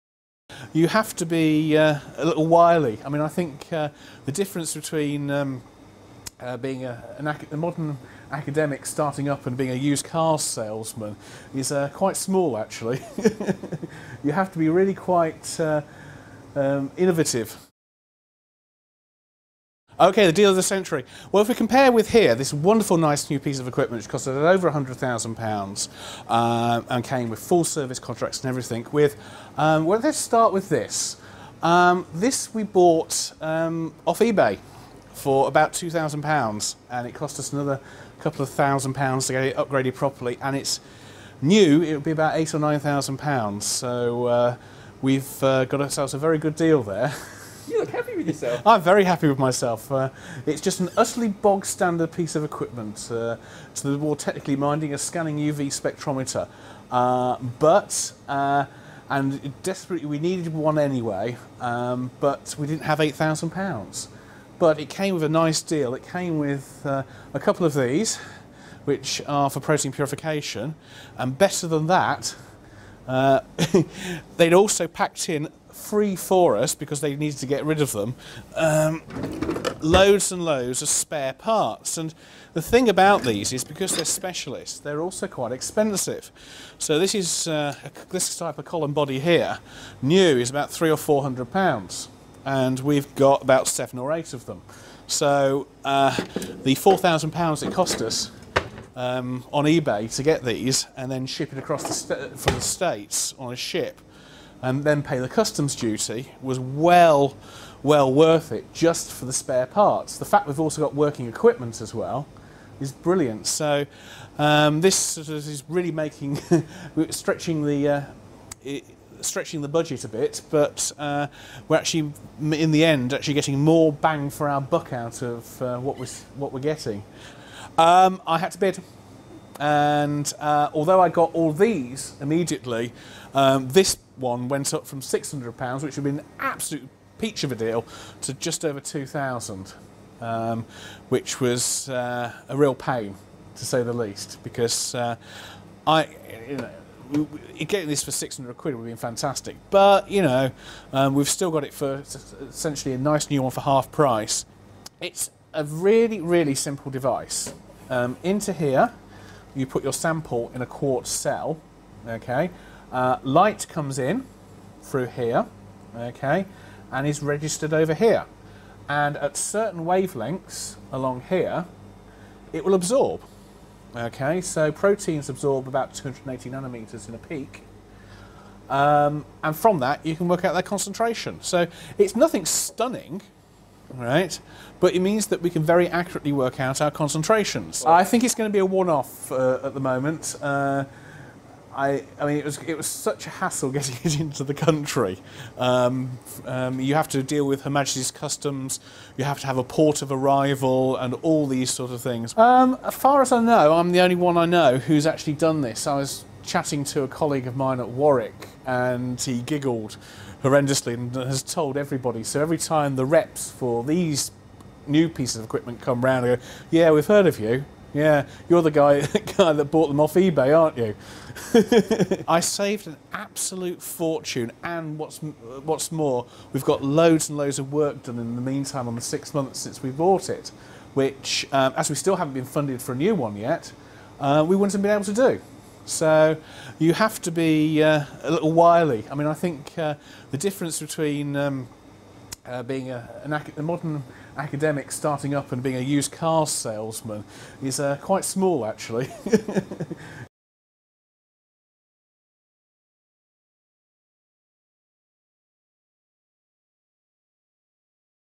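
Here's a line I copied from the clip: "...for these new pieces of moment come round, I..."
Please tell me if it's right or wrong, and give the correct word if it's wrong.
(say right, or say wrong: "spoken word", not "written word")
wrong: "equipment", not "moment".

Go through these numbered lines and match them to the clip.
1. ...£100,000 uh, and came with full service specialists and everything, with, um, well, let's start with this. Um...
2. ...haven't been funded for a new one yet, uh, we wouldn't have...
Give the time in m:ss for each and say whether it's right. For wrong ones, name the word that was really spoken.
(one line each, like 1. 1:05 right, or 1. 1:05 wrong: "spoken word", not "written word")
1. 0:24 wrong: "contracts", not "specialists"
2. 3:52 right.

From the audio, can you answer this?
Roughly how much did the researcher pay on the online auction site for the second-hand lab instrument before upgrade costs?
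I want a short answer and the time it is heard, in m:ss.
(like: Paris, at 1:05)
£2,000, at 0:35.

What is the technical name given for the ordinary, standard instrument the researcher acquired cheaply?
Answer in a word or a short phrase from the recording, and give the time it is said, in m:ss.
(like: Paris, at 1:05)
scanning UV spectrometer, at 0:54.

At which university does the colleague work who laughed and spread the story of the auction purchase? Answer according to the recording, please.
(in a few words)
Warwick.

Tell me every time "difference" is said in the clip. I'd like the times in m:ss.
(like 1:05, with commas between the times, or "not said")
0:04, 4:00.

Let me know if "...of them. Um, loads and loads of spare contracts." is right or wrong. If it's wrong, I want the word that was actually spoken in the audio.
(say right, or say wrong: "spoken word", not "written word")
wrong: "parts", not "contracts".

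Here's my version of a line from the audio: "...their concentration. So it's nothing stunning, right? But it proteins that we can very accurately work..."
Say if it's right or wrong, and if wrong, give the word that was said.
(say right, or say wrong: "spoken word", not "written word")
wrong: "means", not "proteins".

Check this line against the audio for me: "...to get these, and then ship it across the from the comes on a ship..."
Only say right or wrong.
wrong.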